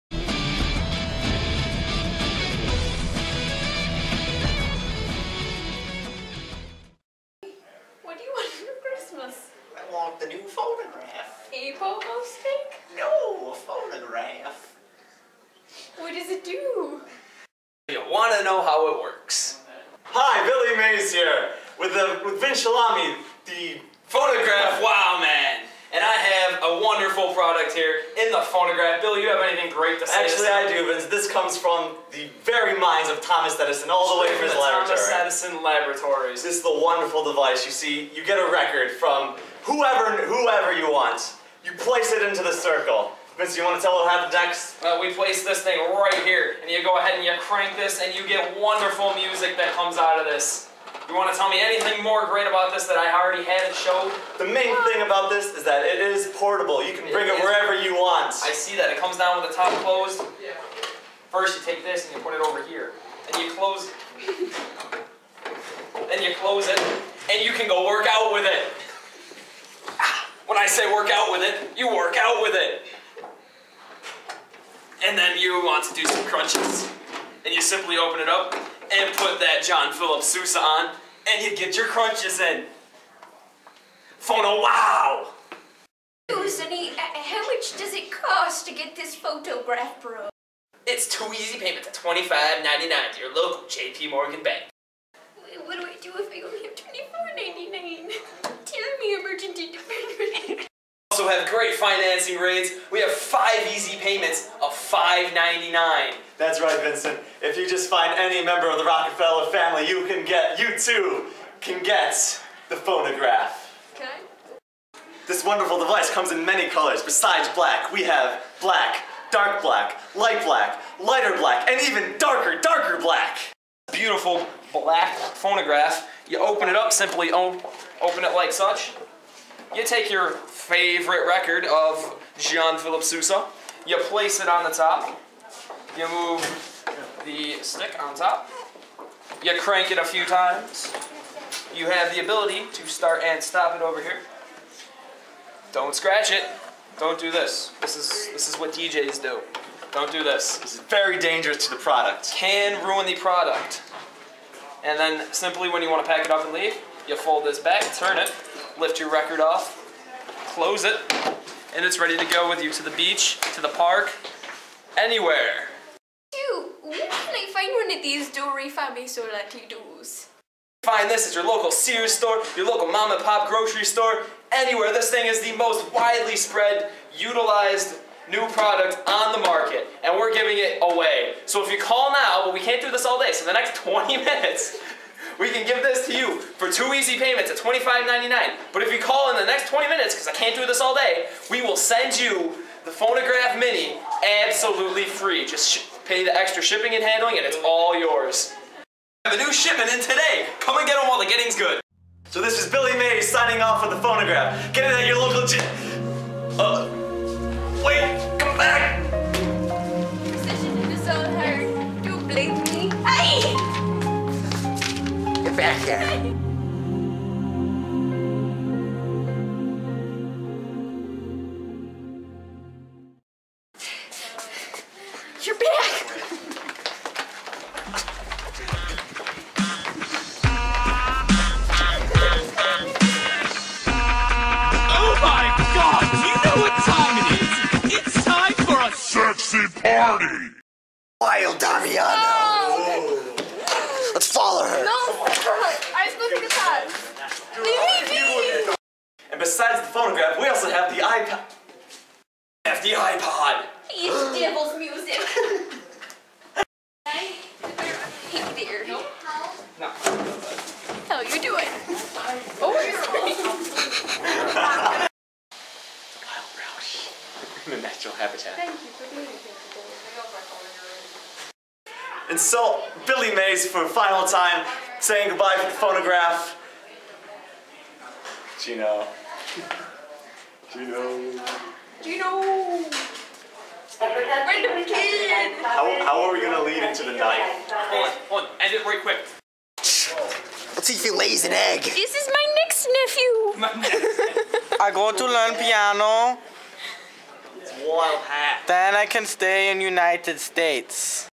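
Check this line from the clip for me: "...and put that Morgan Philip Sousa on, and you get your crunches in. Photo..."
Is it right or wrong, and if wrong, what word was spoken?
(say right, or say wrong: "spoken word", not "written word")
wrong: "John", not "Morgan".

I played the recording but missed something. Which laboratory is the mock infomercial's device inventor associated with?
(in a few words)
Thomas Edison Laboratories.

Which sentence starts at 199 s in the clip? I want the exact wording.
Have a new shipment in today.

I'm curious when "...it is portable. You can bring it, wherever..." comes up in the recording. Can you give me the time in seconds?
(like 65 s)
55 s.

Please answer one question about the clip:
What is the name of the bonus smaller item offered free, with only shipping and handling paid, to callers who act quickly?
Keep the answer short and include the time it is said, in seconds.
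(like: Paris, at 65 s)
Phonograph Mini, at 192 s.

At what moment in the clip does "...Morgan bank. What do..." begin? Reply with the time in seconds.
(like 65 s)
94 s.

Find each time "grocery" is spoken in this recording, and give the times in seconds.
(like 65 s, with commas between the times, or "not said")
173 s.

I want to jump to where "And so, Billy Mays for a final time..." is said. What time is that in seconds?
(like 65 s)
272 s.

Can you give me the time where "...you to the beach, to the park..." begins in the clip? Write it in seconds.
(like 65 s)
162 s.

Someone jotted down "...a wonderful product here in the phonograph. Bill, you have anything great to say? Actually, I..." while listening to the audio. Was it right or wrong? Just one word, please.
right.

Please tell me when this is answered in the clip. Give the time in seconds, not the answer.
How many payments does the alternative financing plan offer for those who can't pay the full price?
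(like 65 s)
103 s.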